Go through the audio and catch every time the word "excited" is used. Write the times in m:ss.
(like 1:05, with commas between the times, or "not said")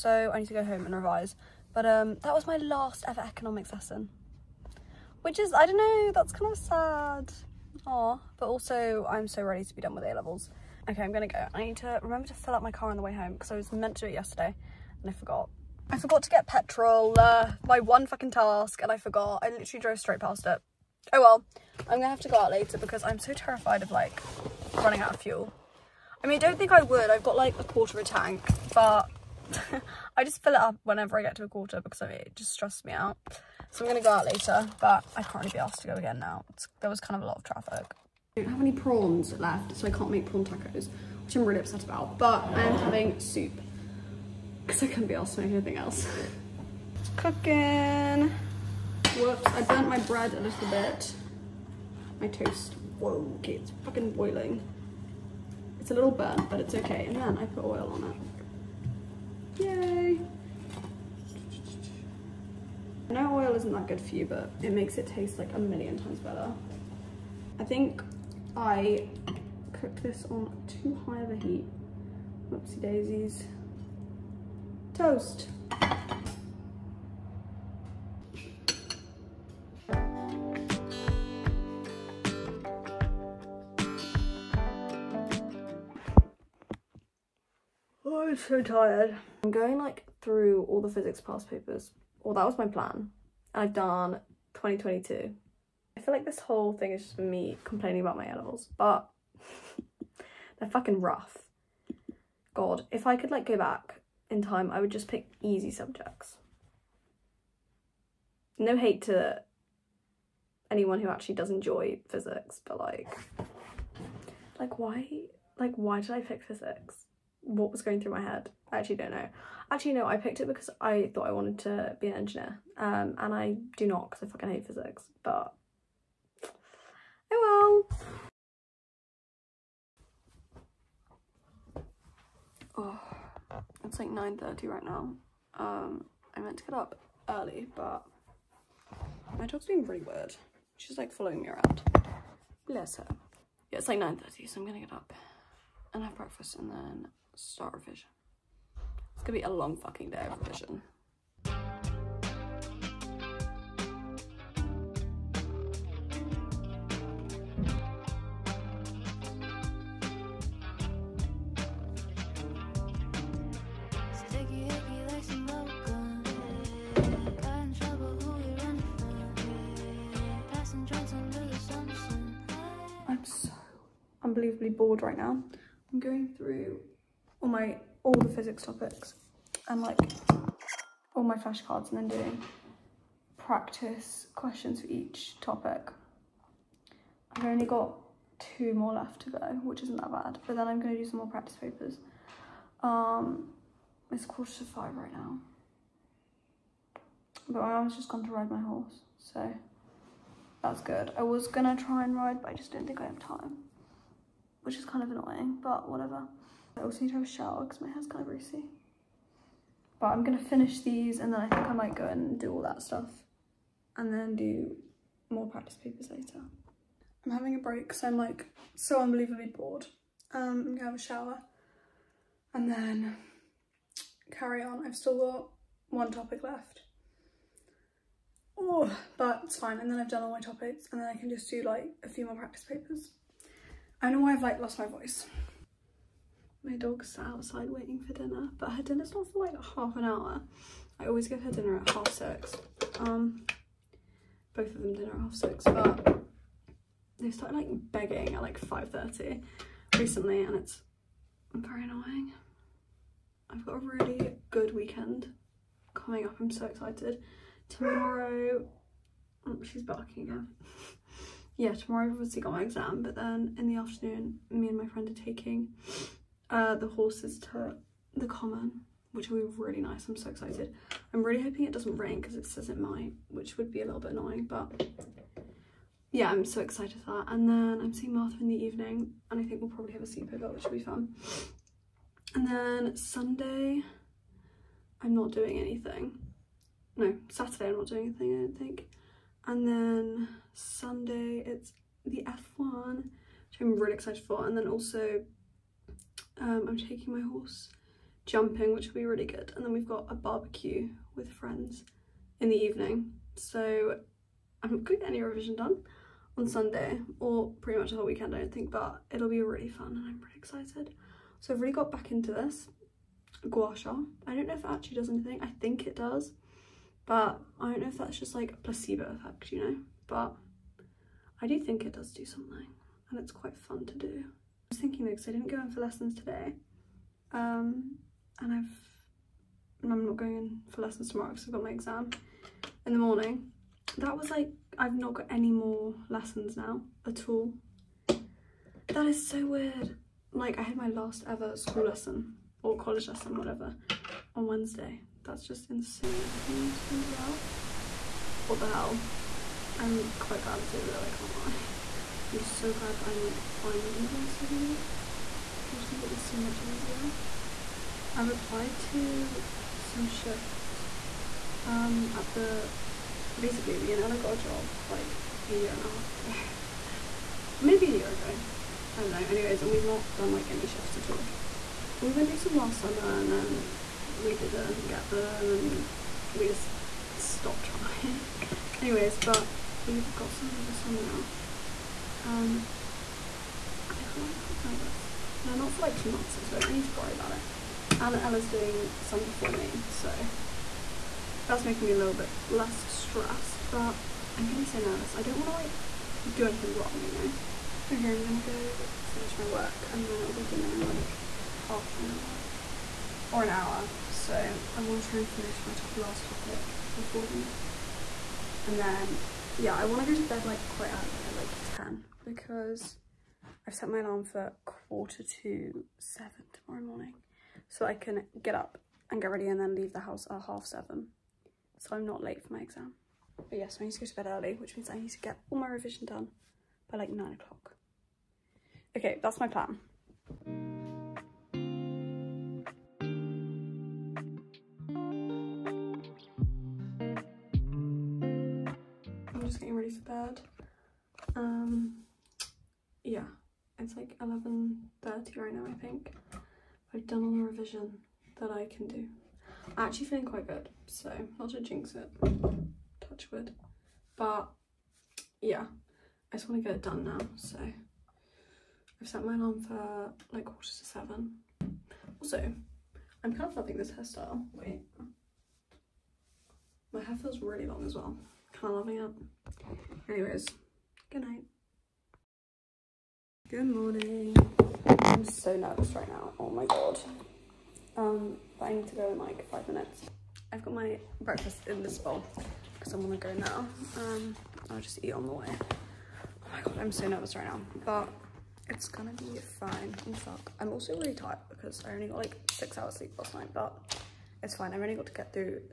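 4:16, 4:30, 4:36, 4:53, 5:10.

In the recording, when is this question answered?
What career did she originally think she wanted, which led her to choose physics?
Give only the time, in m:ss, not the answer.
2:02.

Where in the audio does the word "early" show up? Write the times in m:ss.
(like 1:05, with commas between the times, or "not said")
2:17, 6:50, 7:04.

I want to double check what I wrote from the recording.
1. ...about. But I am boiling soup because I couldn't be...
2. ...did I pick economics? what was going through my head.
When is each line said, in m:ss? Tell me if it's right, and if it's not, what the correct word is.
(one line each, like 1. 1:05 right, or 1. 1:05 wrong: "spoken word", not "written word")
1. 0:41 wrong: "having", not "boiling"
2. 1:56 wrong: "physics", not "economics".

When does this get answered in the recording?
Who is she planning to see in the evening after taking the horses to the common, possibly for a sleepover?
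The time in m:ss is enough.
4:38.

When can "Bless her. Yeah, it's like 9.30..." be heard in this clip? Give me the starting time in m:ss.
2:22.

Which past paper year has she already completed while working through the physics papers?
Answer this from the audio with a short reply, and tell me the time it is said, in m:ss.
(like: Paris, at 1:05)
2022, at 1:34.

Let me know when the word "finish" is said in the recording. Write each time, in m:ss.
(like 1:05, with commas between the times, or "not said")
3:30, 6:39, 6:45.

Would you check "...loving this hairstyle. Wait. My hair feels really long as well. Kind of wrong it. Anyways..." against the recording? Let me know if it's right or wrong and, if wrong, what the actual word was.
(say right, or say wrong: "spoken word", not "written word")
wrong: "loving", not "wrong".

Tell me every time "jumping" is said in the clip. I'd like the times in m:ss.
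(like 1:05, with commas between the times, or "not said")
4:58.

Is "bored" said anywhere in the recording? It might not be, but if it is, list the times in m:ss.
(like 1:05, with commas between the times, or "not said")
2:54, 3:39.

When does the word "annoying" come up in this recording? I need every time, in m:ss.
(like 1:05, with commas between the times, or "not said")
3:25, 4:11, 4:34.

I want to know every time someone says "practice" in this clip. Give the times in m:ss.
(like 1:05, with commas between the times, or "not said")
3:03, 3:11, 3:35, 3:52.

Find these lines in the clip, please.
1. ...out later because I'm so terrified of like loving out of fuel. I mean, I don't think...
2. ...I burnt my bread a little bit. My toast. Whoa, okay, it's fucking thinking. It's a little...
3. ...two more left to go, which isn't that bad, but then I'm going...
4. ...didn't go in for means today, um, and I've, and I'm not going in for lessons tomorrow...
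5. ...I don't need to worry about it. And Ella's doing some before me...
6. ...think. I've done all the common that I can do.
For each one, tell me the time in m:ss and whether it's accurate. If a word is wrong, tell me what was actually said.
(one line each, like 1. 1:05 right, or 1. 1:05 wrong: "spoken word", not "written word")
1. 0:22 wrong: "running", not "loving"
2. 0:49 wrong: "boiling", not "thinking"
3. 3:08 right
4. 5:25 wrong: "lessons", not "means"
5. 6:26 right
6. 7:25 wrong: "revision", not "common".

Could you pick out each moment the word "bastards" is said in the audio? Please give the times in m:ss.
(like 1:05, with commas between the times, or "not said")
not said.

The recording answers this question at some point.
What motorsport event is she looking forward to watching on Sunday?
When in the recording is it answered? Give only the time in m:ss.
4:52.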